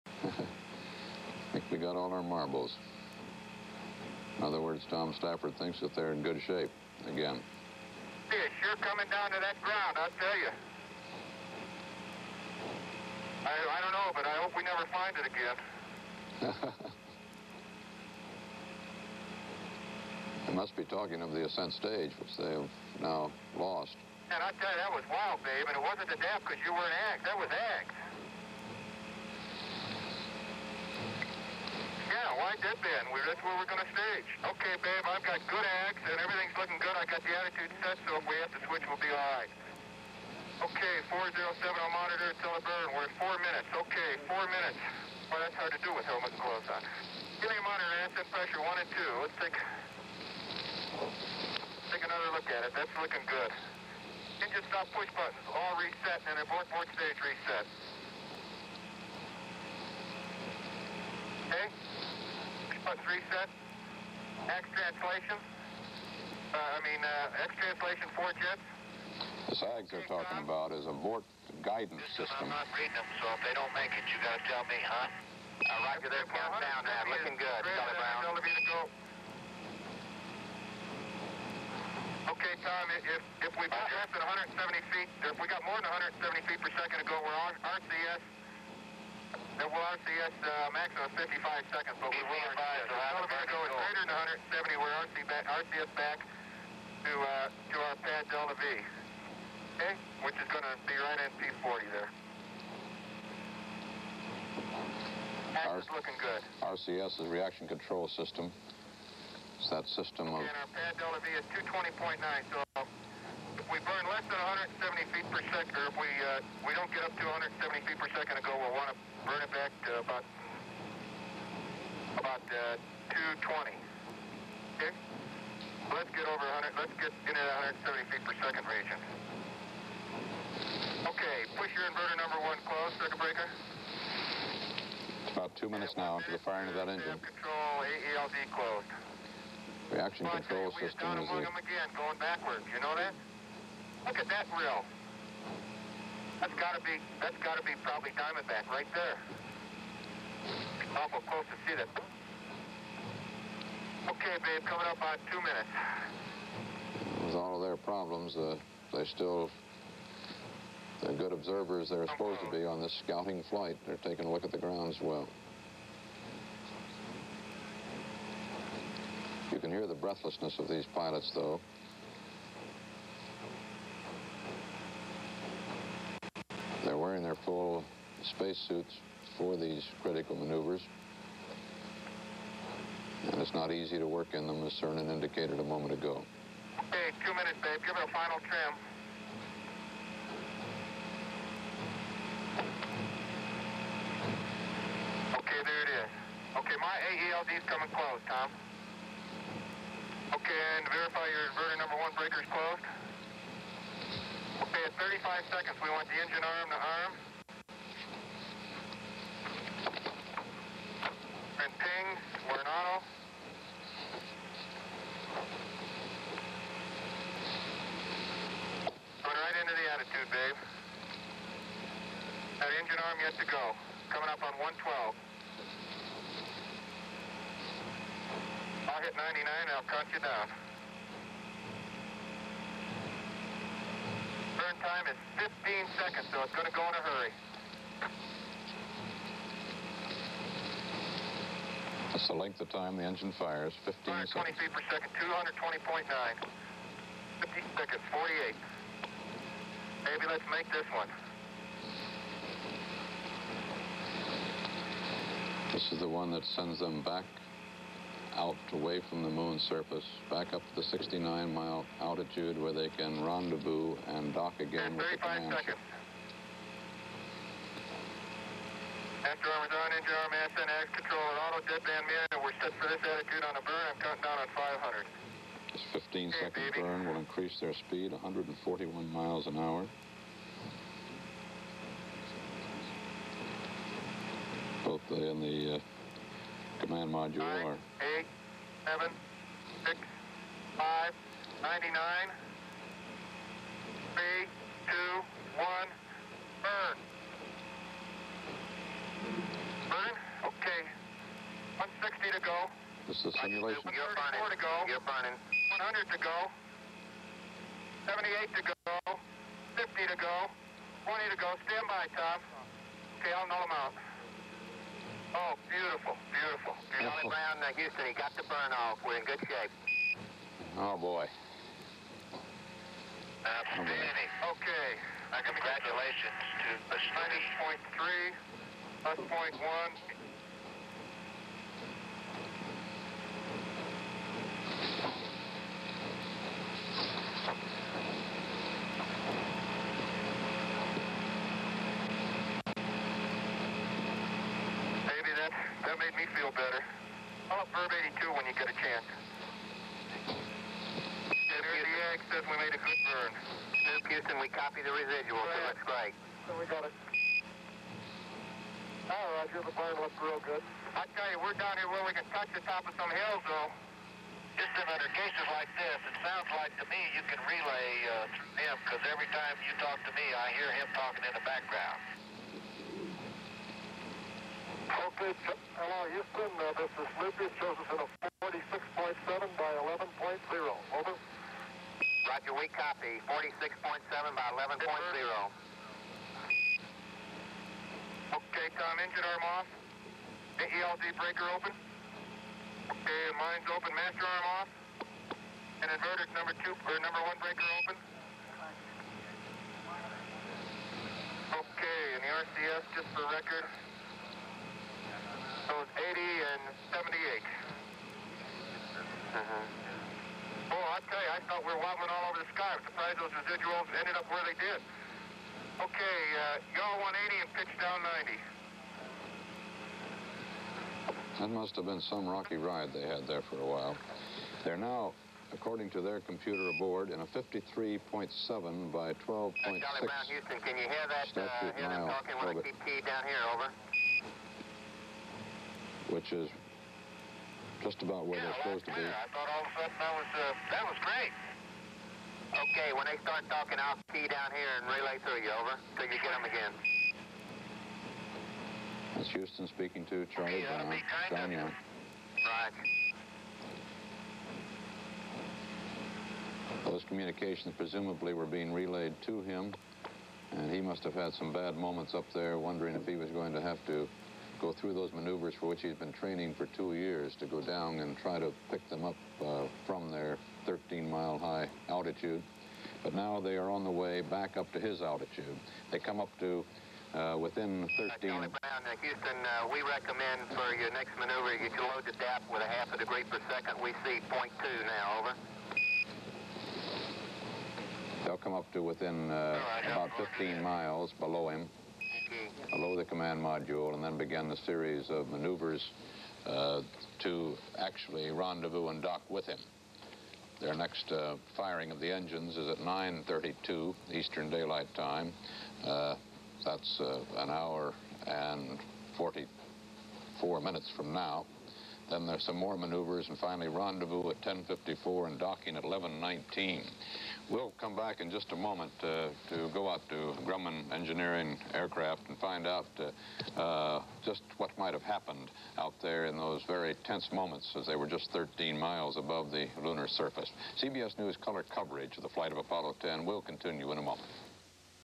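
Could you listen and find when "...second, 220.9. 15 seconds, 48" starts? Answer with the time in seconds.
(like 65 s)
244 s.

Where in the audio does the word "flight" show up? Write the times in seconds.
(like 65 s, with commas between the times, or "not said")
163 s, 532 s.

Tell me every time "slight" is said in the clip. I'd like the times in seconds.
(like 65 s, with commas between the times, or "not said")
not said.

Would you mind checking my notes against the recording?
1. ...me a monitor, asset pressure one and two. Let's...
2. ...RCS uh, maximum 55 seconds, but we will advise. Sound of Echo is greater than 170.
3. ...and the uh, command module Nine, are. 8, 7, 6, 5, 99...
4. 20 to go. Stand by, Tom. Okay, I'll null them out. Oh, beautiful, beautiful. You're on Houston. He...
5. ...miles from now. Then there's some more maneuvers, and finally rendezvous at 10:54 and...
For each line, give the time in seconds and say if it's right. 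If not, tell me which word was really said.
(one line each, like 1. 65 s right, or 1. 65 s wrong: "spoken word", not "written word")
1. 47 s right
2. 89 s right
3. 285 s right
4. 311 s right
5. 510 s wrong: "minutes", not "miles".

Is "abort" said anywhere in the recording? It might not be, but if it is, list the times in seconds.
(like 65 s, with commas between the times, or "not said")
56 s, 70 s.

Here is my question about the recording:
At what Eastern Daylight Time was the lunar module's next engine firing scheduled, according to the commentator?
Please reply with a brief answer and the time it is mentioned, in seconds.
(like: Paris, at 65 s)
9:32, at 502 s.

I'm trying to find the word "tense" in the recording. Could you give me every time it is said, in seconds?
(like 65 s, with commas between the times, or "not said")
527 s.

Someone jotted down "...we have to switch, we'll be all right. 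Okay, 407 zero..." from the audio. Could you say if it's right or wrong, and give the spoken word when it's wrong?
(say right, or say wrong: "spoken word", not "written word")
right.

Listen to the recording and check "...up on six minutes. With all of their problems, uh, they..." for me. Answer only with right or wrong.
wrong.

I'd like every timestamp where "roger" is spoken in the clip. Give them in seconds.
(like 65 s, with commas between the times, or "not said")
75 s, 359 s, 382 s.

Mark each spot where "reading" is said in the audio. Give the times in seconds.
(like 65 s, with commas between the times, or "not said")
72 s.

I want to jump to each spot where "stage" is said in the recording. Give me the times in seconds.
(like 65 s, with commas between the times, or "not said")
21 s, 33 s, 56 s.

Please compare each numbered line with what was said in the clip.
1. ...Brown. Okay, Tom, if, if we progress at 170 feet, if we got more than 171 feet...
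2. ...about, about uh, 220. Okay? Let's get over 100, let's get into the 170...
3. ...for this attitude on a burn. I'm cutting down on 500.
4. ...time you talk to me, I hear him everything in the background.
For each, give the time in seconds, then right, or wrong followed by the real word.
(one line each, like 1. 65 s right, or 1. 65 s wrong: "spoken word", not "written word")
1. 78 s wrong: "170", not "171"
2. 120 s right
3. 272 s right
4. 369 s wrong: "talking", not "everything".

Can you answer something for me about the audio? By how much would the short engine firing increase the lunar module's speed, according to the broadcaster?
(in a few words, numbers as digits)
141 miles an hour.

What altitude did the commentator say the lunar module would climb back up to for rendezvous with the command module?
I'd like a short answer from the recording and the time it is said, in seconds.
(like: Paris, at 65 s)
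69 miles, at 260 s.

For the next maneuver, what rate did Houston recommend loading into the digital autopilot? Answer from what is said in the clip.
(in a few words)
Half a degree per second.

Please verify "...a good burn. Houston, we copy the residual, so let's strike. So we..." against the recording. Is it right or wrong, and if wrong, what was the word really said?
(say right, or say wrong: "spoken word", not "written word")
right.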